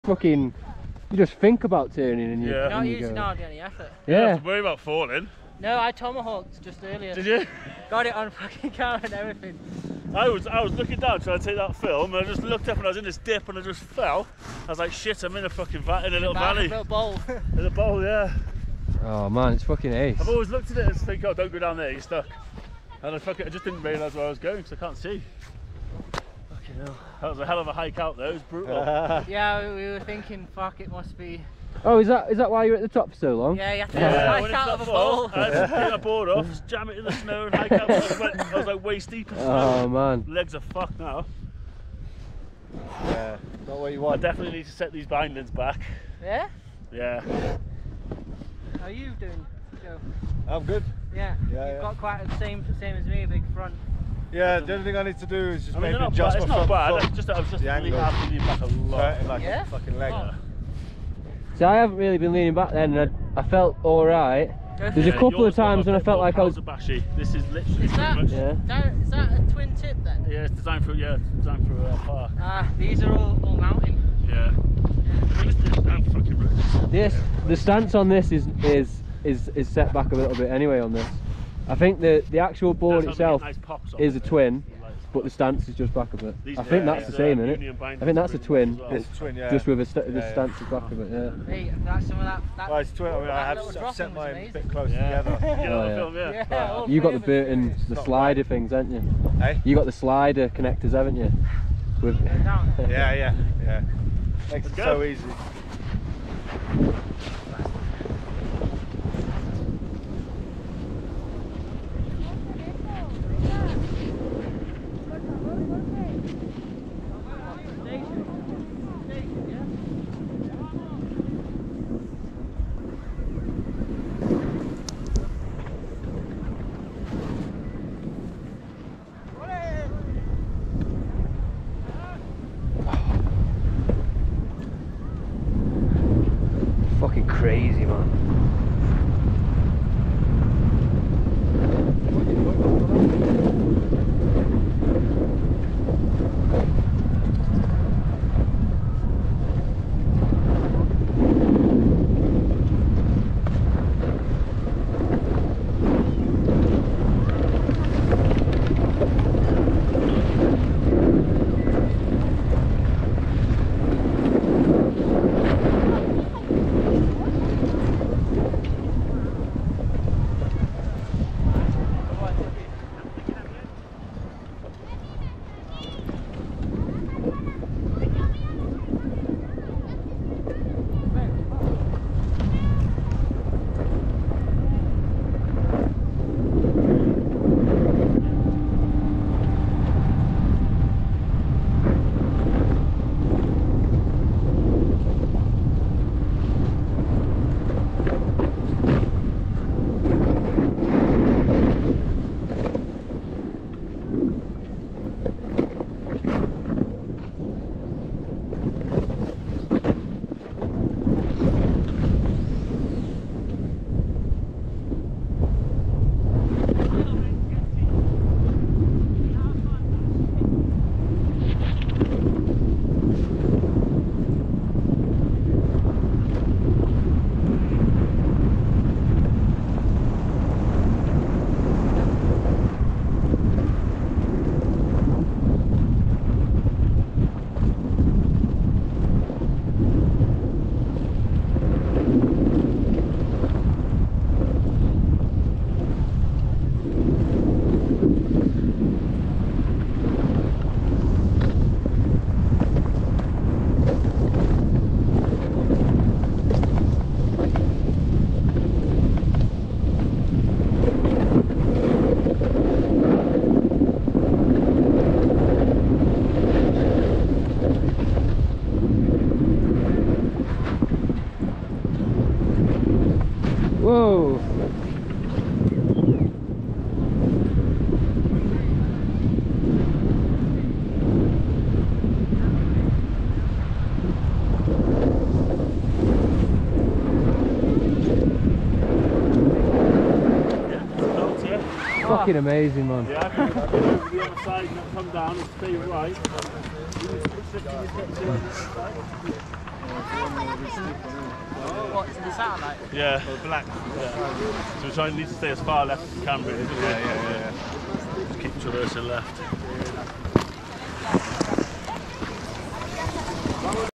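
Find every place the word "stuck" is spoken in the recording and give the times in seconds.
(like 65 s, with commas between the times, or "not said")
22 s.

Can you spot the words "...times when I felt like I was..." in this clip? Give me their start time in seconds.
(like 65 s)
65 s.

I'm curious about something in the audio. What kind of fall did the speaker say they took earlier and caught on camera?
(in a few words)
Tomahawked.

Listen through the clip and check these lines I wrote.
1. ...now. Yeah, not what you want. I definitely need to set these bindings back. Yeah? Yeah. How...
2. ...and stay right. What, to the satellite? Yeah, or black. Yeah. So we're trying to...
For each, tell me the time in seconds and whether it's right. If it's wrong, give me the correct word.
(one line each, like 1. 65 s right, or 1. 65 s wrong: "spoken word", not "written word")
1. 40 s right
2. 295 s right.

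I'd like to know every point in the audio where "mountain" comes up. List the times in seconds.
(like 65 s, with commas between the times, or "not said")
73 s.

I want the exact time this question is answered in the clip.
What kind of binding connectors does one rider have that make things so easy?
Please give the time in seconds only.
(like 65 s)
99 s.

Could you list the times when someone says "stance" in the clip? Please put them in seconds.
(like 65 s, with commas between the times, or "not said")
77 s, 85 s, 90 s.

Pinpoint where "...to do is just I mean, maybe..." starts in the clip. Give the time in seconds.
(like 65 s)
55 s.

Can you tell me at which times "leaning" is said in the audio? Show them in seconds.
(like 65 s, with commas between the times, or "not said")
57 s, 62 s.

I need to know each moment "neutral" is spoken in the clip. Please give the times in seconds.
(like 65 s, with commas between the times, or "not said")
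not said.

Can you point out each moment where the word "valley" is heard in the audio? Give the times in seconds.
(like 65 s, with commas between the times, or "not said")
16 s.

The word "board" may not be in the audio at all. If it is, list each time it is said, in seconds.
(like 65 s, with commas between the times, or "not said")
35 s, 82 s.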